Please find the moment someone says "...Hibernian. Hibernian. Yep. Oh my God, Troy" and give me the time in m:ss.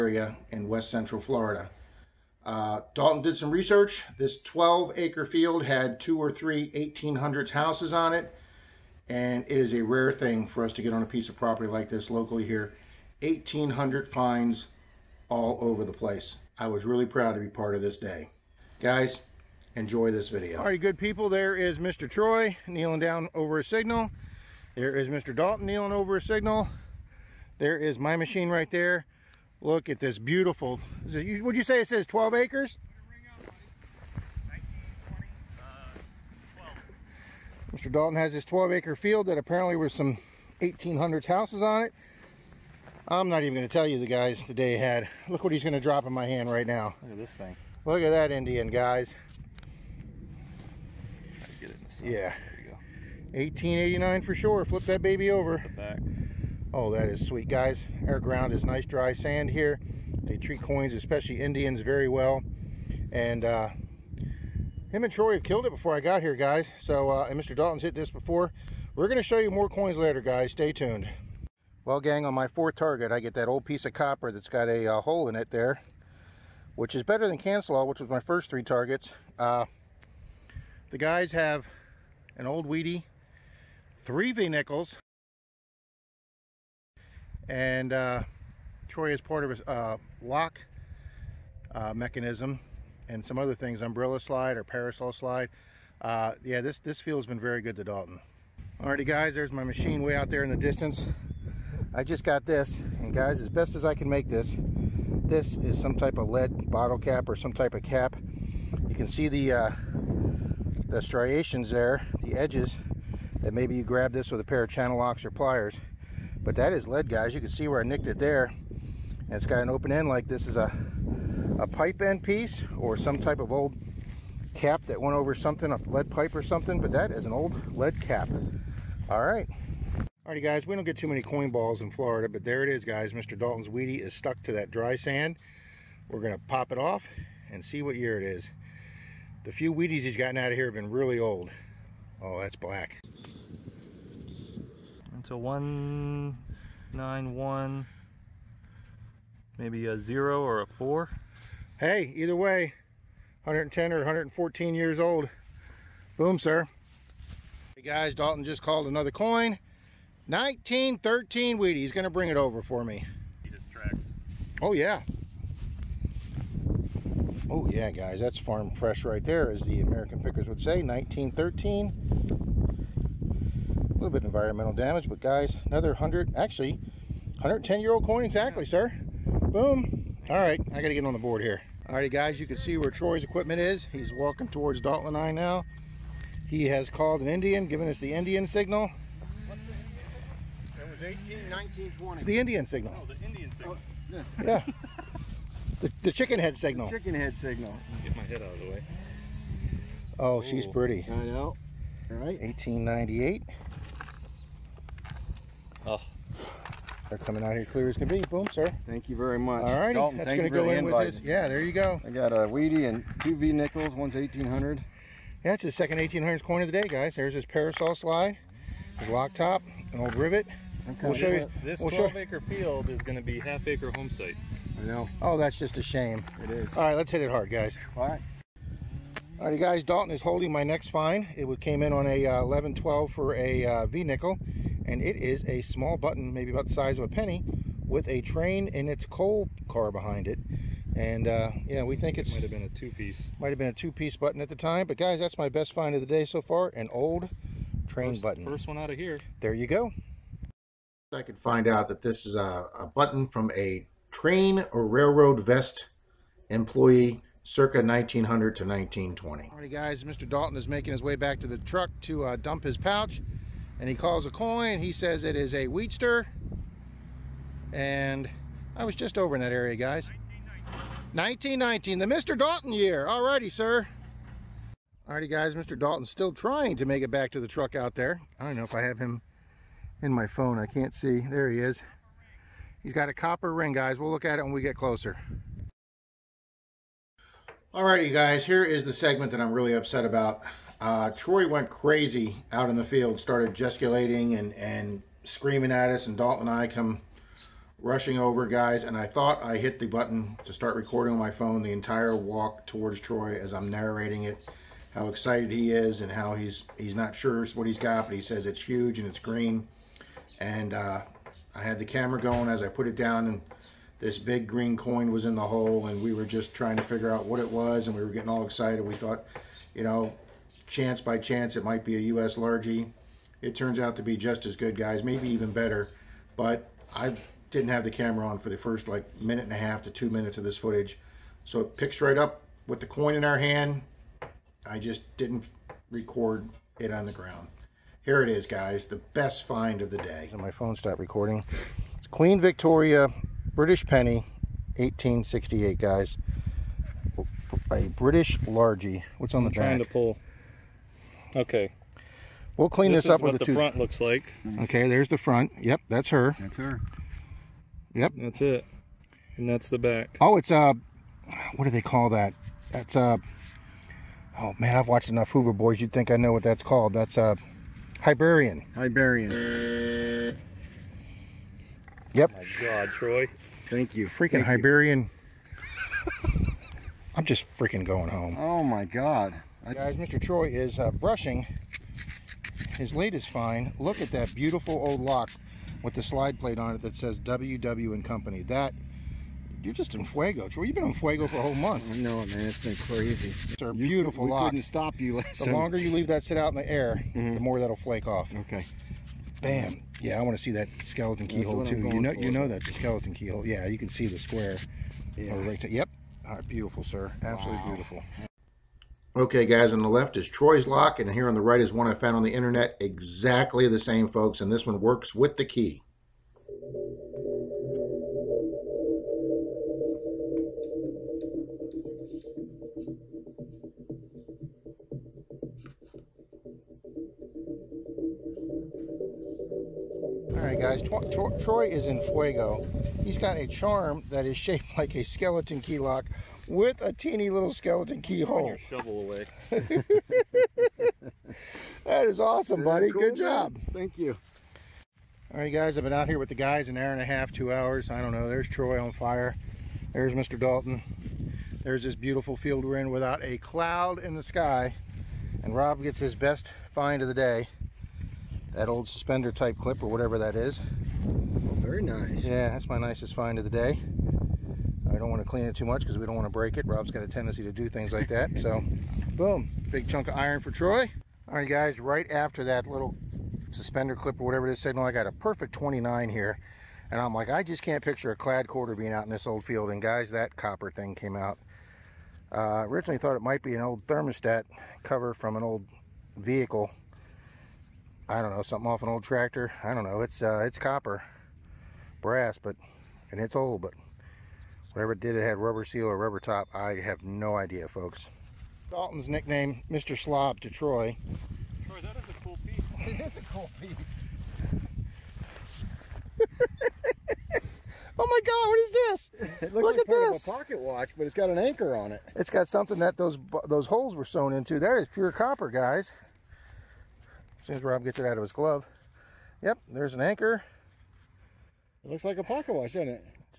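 6:08.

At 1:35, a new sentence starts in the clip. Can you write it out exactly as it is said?
Uh, yeah, this, this field's been very good to Dalton.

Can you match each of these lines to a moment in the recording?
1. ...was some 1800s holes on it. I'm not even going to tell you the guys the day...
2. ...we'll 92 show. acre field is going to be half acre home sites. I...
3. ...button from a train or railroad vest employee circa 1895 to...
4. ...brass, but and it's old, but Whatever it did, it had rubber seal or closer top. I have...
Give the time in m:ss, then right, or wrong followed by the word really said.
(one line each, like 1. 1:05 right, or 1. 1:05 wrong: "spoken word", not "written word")
1. 0:39 wrong: "houses", not "holes"
2. 3:41 wrong: "12", not "92"
3. 4:12 wrong: "1900", not "1895"
4. 8:12 wrong: "rubber", not "closer".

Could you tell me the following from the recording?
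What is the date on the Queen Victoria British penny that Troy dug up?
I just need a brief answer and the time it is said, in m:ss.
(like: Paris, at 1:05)
1868, at 5:44.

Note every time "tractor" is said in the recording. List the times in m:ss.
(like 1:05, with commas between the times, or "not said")
8:09.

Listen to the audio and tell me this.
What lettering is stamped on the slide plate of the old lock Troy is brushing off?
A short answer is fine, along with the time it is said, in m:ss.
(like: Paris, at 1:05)
WW and Company, at 6:27.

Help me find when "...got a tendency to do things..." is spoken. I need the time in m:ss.
7:46.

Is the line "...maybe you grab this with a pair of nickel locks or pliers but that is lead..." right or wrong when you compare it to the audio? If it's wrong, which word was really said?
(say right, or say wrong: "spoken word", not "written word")
wrong: "channel", not "nickel".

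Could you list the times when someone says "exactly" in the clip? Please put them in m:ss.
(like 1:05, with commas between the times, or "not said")
2:58, 6:52.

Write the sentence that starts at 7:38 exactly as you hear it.
That old suspender type clip or whatever that is.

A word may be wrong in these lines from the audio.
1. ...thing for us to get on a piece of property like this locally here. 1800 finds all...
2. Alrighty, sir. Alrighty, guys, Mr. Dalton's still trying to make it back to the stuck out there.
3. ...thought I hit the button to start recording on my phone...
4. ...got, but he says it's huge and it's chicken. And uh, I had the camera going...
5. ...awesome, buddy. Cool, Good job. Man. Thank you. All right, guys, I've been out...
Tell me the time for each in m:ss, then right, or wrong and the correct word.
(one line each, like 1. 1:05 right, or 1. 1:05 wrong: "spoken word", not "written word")
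1. 0:10 right
2. 4:33 wrong: "truck", not "stuck"
3. 4:59 right
4. 5:07 wrong: "green", not "chicken"
5. 7:22 right.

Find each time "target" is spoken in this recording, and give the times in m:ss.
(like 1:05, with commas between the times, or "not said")
1:12, 1:18.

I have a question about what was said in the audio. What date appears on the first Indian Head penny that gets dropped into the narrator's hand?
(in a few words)
1889.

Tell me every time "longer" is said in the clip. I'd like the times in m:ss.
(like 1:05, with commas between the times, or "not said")
6:35.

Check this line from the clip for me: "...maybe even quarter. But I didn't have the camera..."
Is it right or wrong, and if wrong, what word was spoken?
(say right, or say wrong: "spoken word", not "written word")
wrong: "better", not "quarter".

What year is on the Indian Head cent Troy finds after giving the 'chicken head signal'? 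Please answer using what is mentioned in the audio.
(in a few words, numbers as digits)
1898.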